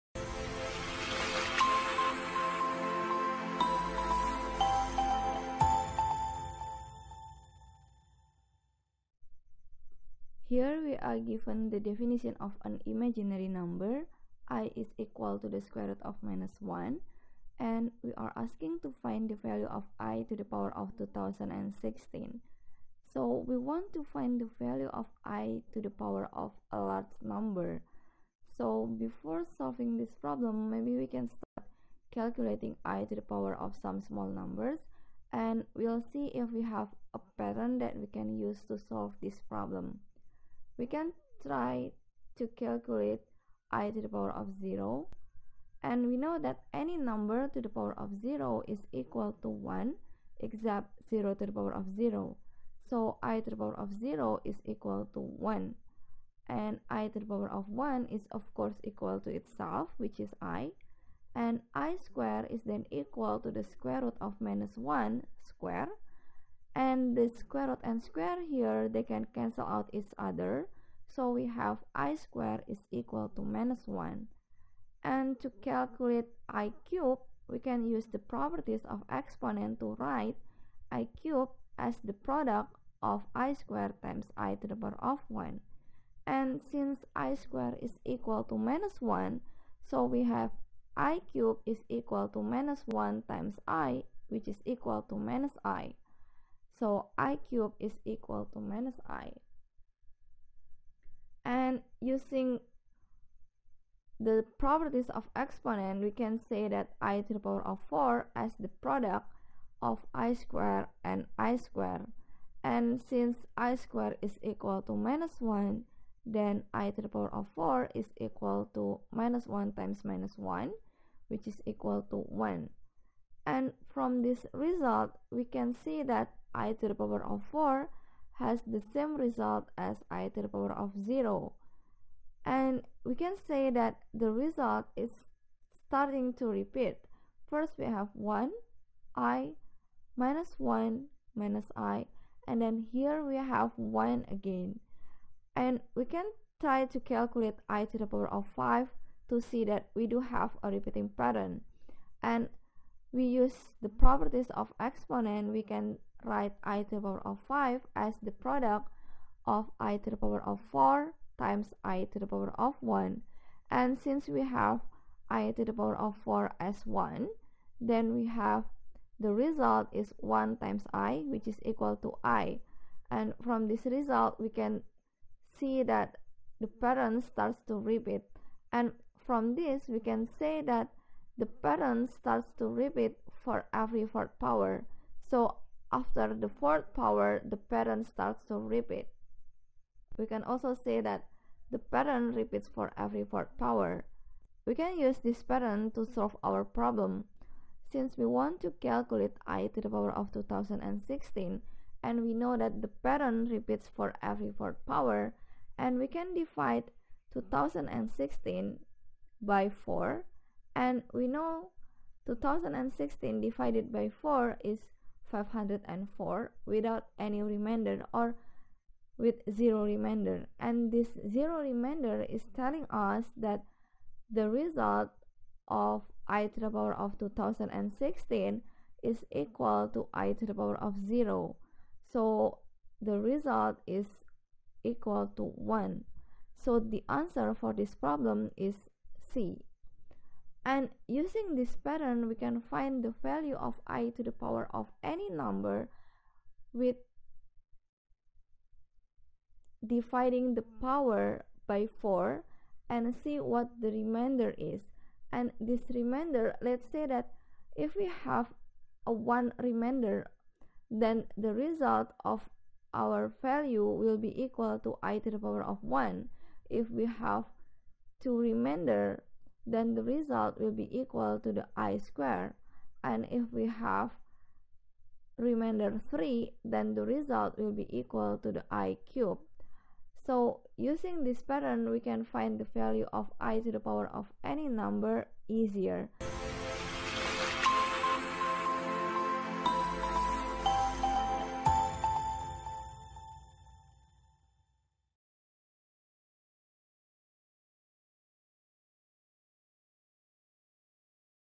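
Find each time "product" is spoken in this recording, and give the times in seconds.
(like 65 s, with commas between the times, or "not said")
82 s, 108 s, 158 s.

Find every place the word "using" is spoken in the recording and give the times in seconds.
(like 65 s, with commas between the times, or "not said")
101 s, 241 s, 280 s.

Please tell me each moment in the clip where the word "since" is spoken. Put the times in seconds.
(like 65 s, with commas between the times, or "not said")
86 s, 112 s, 163 s, 197 s.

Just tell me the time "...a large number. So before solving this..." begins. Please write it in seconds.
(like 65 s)
26 s.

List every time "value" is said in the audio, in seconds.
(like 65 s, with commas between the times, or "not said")
19 s, 24 s, 243 s, 263 s, 282 s.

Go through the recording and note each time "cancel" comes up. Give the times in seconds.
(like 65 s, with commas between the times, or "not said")
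69 s.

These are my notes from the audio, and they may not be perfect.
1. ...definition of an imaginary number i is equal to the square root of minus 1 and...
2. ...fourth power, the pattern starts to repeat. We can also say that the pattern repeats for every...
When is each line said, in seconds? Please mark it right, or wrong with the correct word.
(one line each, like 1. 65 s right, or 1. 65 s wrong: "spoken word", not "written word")
1. 11 s right
2. 186 s right.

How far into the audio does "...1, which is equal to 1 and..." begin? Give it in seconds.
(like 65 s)
120 s.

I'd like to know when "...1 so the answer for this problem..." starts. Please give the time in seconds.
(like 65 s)
235 s.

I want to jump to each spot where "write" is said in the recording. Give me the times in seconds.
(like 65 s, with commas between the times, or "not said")
79 s, 156 s.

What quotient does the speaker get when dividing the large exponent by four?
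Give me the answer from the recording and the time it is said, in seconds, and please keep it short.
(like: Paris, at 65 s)
504, at 215 s.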